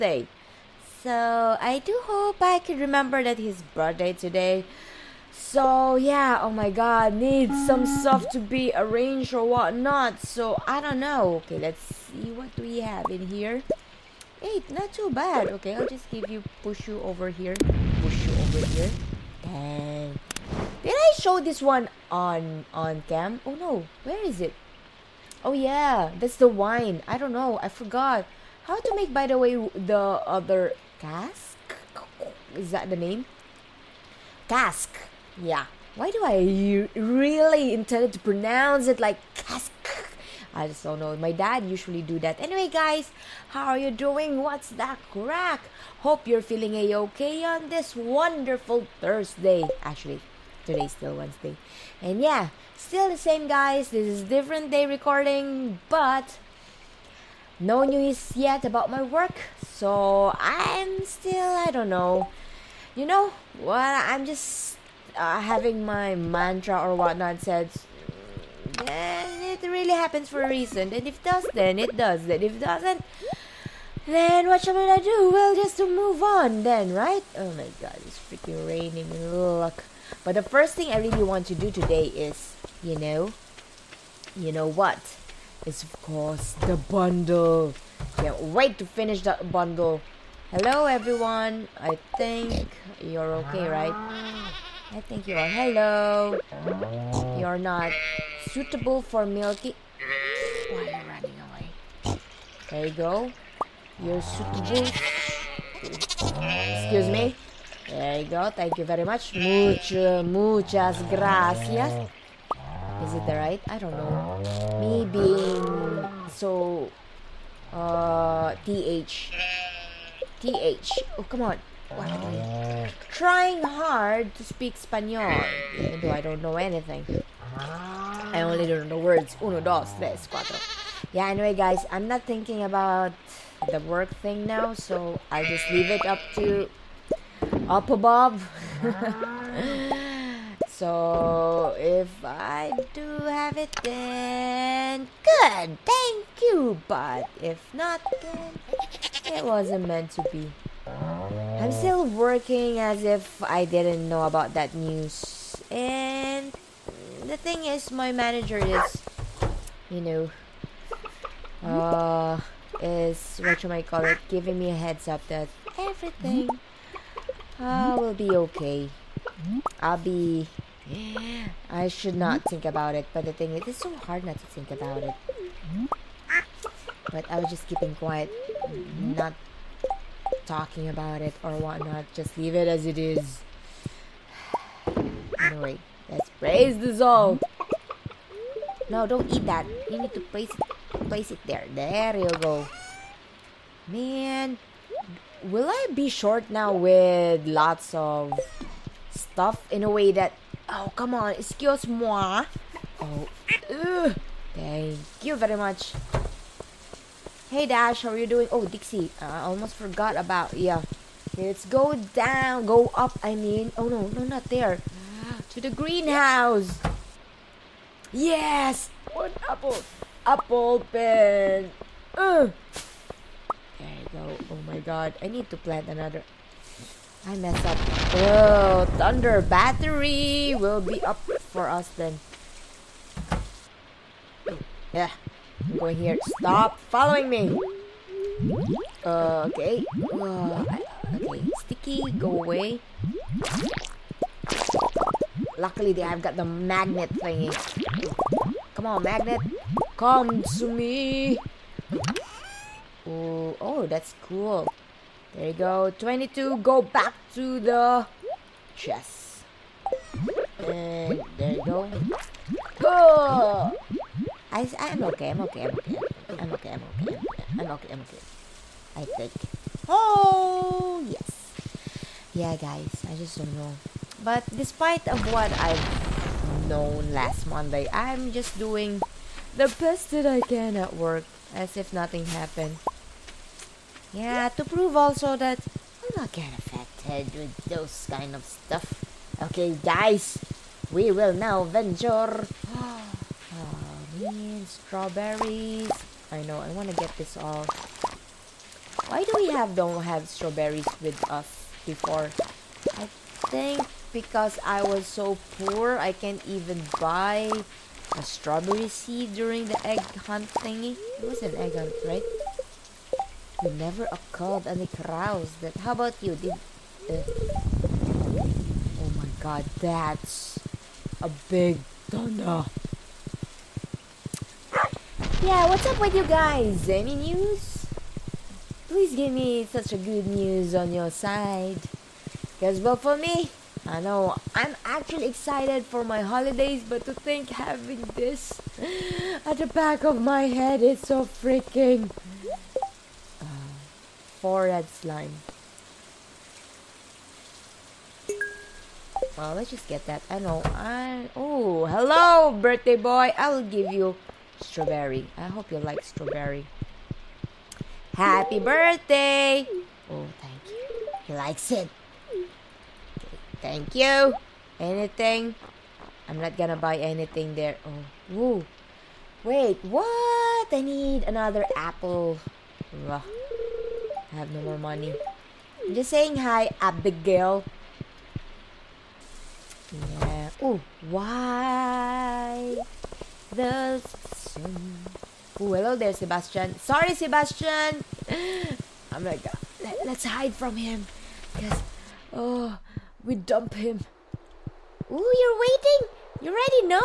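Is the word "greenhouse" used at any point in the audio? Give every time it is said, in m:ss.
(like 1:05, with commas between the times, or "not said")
3:35.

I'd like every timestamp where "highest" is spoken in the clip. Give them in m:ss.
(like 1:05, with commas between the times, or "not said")
not said.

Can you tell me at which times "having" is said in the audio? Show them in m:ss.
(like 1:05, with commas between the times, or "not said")
1:05, 5:37.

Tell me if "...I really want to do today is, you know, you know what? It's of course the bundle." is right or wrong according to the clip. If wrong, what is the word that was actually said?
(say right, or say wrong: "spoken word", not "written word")
right.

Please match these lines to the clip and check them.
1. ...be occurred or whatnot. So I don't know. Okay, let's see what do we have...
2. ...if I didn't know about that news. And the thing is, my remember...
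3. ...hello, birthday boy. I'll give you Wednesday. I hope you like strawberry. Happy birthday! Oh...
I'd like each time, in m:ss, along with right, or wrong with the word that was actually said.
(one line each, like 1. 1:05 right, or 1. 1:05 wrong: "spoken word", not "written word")
1. 0:08 wrong: "arranged", not "occurred"
2. 2:33 wrong: "manager", not "remember"
3. 5:51 wrong: "Strawberry", not "Wednesday".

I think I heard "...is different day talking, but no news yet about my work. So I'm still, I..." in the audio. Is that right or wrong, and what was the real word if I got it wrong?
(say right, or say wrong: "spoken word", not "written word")
wrong: "recording", not "talking".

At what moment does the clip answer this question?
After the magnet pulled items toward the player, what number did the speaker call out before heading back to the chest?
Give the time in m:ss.
4:15.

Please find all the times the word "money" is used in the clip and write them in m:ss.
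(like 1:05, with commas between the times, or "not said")
6:14.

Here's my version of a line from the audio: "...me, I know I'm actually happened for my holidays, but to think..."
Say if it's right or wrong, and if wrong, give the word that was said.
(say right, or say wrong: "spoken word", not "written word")
wrong: "excited", not "happened".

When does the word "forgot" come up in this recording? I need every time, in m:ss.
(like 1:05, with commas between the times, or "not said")
0:27, 3:29.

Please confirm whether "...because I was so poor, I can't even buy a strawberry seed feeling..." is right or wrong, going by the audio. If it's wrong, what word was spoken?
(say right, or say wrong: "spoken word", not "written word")
wrong: "during", not "feeling".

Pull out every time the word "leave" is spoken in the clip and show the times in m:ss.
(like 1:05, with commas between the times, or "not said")
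2:15, 3:02.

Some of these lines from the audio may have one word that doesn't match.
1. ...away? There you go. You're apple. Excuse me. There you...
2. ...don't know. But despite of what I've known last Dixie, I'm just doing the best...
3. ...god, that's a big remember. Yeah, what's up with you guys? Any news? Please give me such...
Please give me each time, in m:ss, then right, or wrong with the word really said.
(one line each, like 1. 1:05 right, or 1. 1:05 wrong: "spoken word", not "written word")
1. 1:41 wrong: "suitable", not "apple"
2. 4:33 wrong: "Monday", not "Dixie"
3. 5:19 wrong: "thunder", not "remember".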